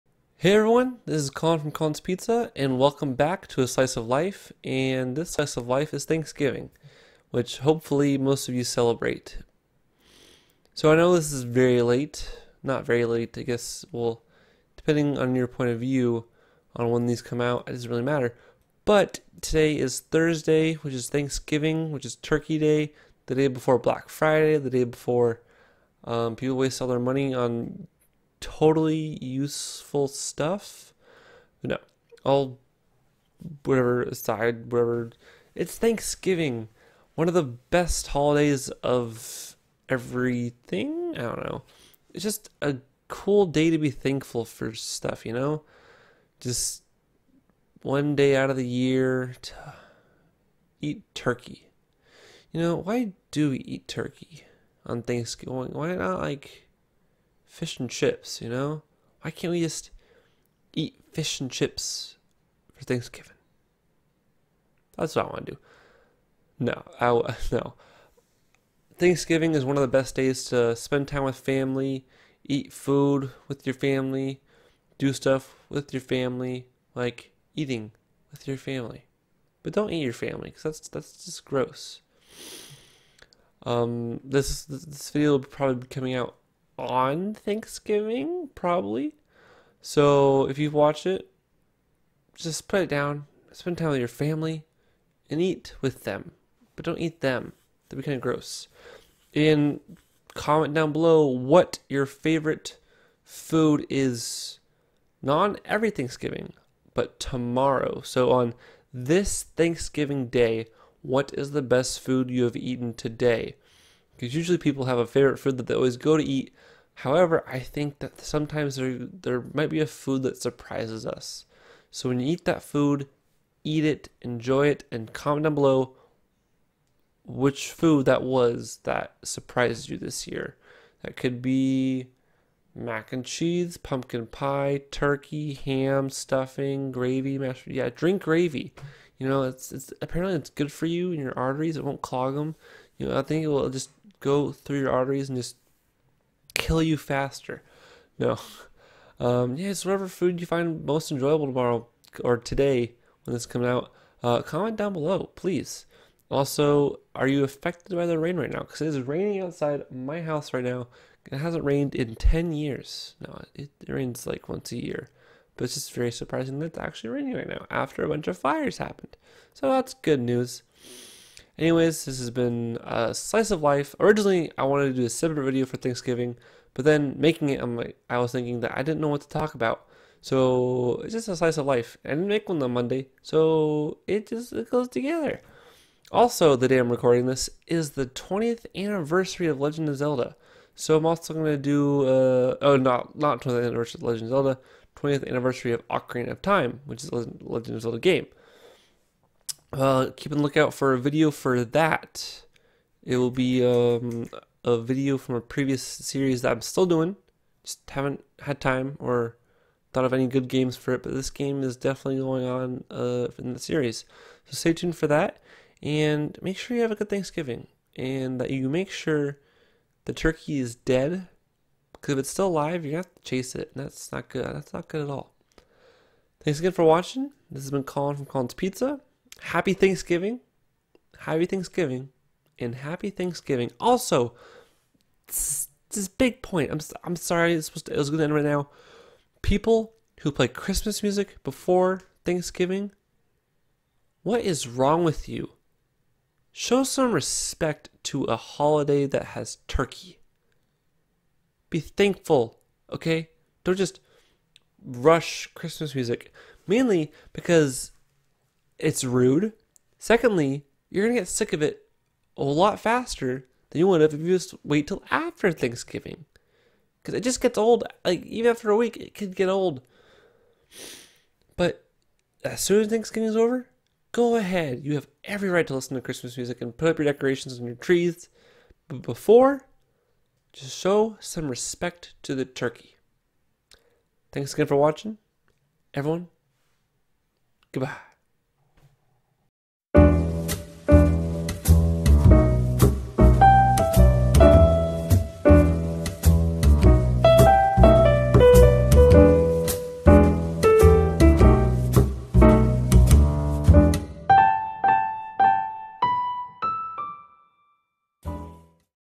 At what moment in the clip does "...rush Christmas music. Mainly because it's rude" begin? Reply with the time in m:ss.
4:14.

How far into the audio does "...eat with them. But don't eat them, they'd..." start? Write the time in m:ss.
1:35.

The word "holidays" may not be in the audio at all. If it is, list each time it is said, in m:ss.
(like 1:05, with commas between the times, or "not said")
0:38, 4:08.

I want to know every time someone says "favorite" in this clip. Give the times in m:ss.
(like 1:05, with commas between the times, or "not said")
1:42, 1:55.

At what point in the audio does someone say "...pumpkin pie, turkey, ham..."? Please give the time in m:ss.
2:13.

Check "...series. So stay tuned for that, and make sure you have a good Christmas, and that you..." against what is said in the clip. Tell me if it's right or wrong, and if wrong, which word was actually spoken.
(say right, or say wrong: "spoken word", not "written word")
wrong: "Thanksgiving", not "Christmas".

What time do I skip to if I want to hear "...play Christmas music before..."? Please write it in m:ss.
4:00.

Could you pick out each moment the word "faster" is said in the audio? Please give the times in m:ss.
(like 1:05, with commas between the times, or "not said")
2:26, 4:22.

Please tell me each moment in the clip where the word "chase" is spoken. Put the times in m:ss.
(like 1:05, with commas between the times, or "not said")
3:43.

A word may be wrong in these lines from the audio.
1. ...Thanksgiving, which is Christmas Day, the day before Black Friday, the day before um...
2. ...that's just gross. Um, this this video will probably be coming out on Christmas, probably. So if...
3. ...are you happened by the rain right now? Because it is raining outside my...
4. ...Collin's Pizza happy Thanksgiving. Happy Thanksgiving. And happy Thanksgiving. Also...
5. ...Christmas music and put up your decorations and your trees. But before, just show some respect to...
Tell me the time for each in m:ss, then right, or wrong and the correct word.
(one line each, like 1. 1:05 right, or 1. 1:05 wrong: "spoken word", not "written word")
1. 0:21 wrong: "Turkey", not "Christmas"
2. 1:20 wrong: "Thanksgiving", not "Christmas"
3. 2:37 wrong: "affected", not "happened"
4. 3:48 right
5. 4:36 right.